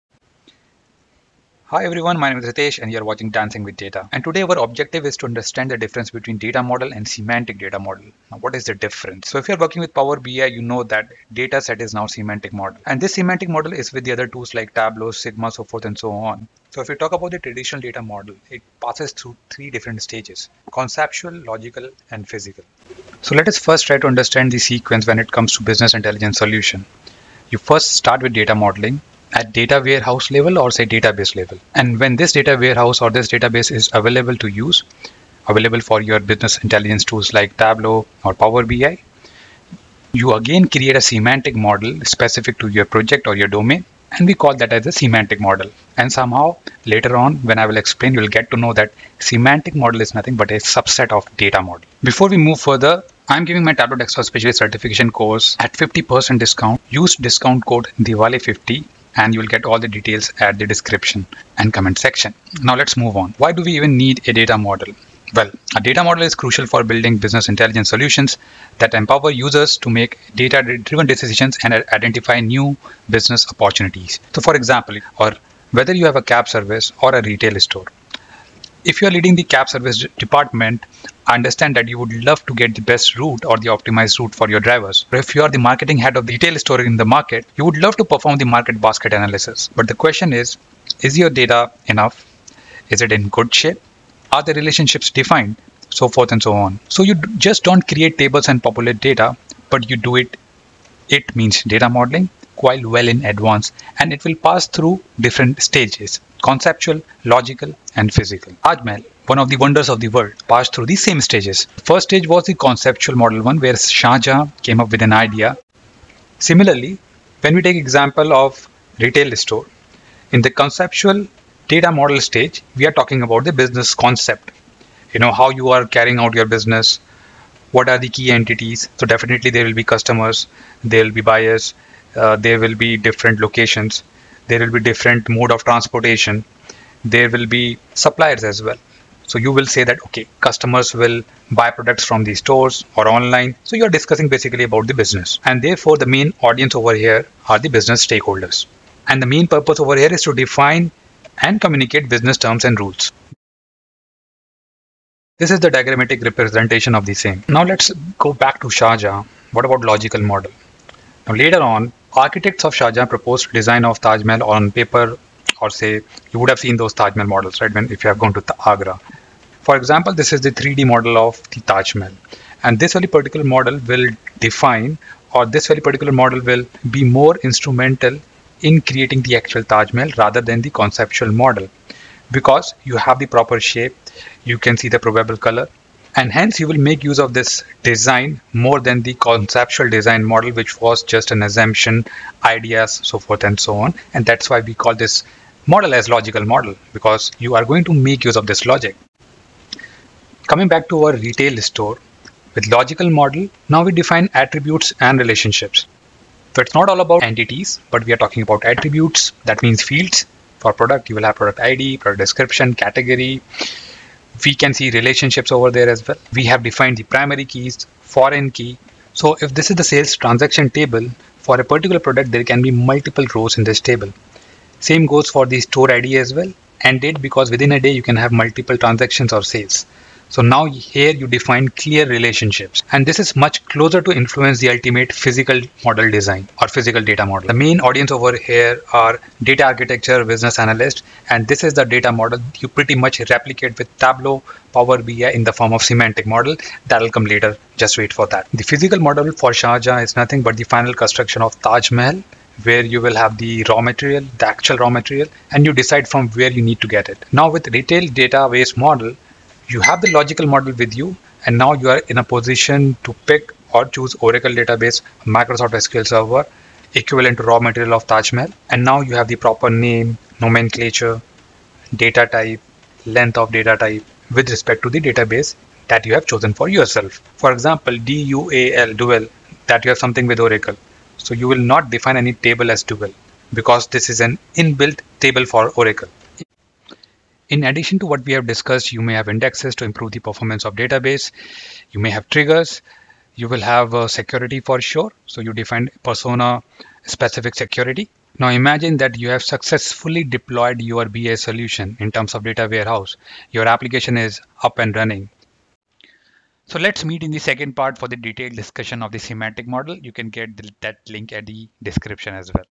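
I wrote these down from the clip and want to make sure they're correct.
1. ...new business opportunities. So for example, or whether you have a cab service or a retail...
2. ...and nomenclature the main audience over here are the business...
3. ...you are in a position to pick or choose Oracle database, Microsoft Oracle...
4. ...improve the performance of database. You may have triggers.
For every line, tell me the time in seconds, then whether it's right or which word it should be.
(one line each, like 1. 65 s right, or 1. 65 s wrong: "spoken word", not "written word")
1. 72 s right
2. 145 s wrong: "therefore", not "nomenclature"
3. 261 s wrong: "SQL", not "Oracle"
4. 289 s right.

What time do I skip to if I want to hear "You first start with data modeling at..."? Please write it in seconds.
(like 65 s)
27 s.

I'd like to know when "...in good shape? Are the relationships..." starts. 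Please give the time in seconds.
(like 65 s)
93 s.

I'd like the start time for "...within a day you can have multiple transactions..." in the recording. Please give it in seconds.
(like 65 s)
227 s.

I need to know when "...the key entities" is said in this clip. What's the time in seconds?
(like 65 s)
127 s.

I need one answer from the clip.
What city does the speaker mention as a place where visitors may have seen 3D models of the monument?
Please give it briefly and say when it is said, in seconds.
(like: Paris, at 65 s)
Agra, at 168 s.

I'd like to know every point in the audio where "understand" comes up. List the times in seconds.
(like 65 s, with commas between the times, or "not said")
5 s, 24 s, 81 s.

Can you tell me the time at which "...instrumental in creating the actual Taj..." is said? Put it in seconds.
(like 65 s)
177 s.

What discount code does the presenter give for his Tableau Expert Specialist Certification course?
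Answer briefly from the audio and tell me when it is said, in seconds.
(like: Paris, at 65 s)
Diwali50, at 57 s.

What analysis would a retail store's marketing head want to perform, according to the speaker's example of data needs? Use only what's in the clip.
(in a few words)
Market basket analysis.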